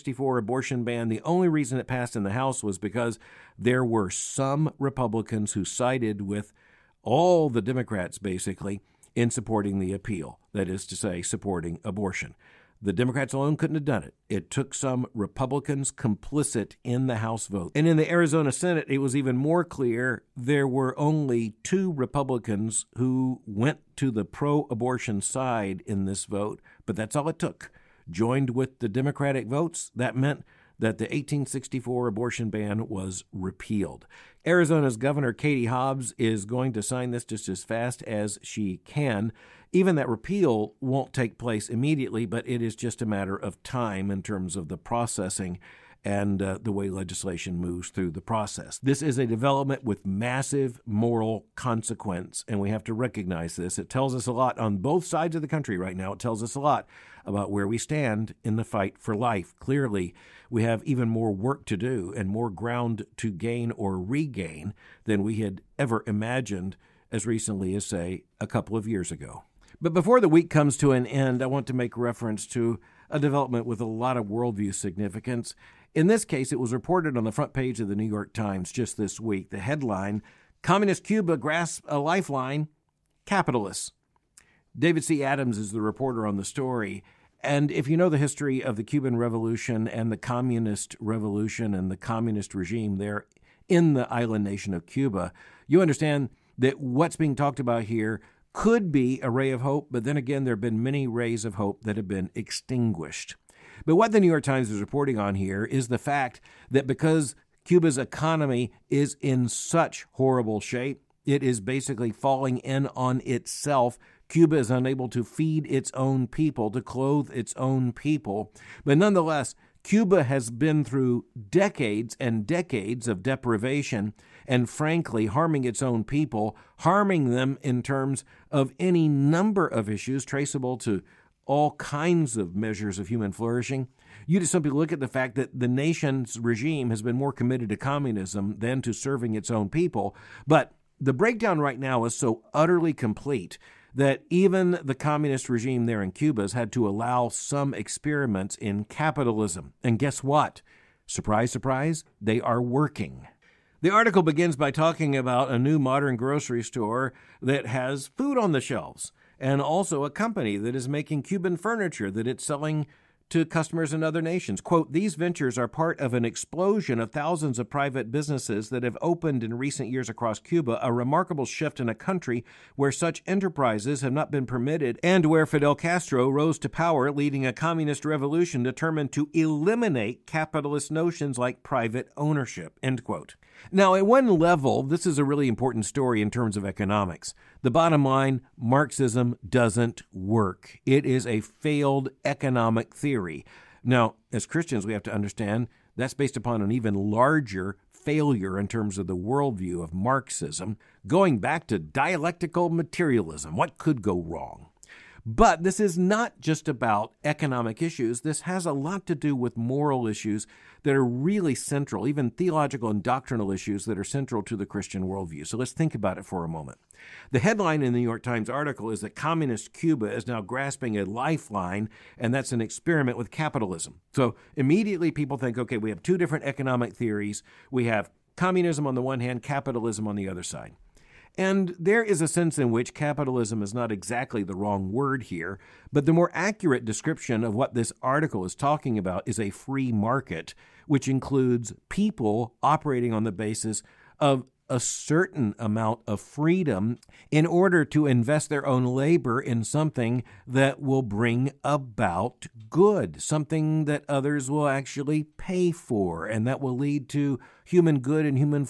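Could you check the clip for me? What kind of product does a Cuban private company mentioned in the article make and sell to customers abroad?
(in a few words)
Furniture.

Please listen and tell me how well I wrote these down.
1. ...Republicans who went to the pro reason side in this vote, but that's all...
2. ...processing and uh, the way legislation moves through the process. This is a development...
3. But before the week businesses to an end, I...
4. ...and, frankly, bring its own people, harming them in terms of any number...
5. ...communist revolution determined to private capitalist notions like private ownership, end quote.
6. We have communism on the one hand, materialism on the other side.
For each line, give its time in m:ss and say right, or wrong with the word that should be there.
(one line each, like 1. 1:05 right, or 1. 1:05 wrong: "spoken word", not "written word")
1. 0:21 wrong: "abortion", not "reason"
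2. 0:44 right
3. 1:09 wrong: "comes", not "businesses"
4. 2:04 wrong: "harming", not "bring"
5. 2:57 wrong: "eliminate", not "private"
6. 3:47 wrong: "capitalism", not "materialism".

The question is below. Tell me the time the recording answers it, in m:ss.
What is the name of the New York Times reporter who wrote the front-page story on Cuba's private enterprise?
1:24.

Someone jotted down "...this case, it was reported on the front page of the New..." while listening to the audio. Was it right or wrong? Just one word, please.
right.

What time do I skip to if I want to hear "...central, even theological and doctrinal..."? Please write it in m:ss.
3:31.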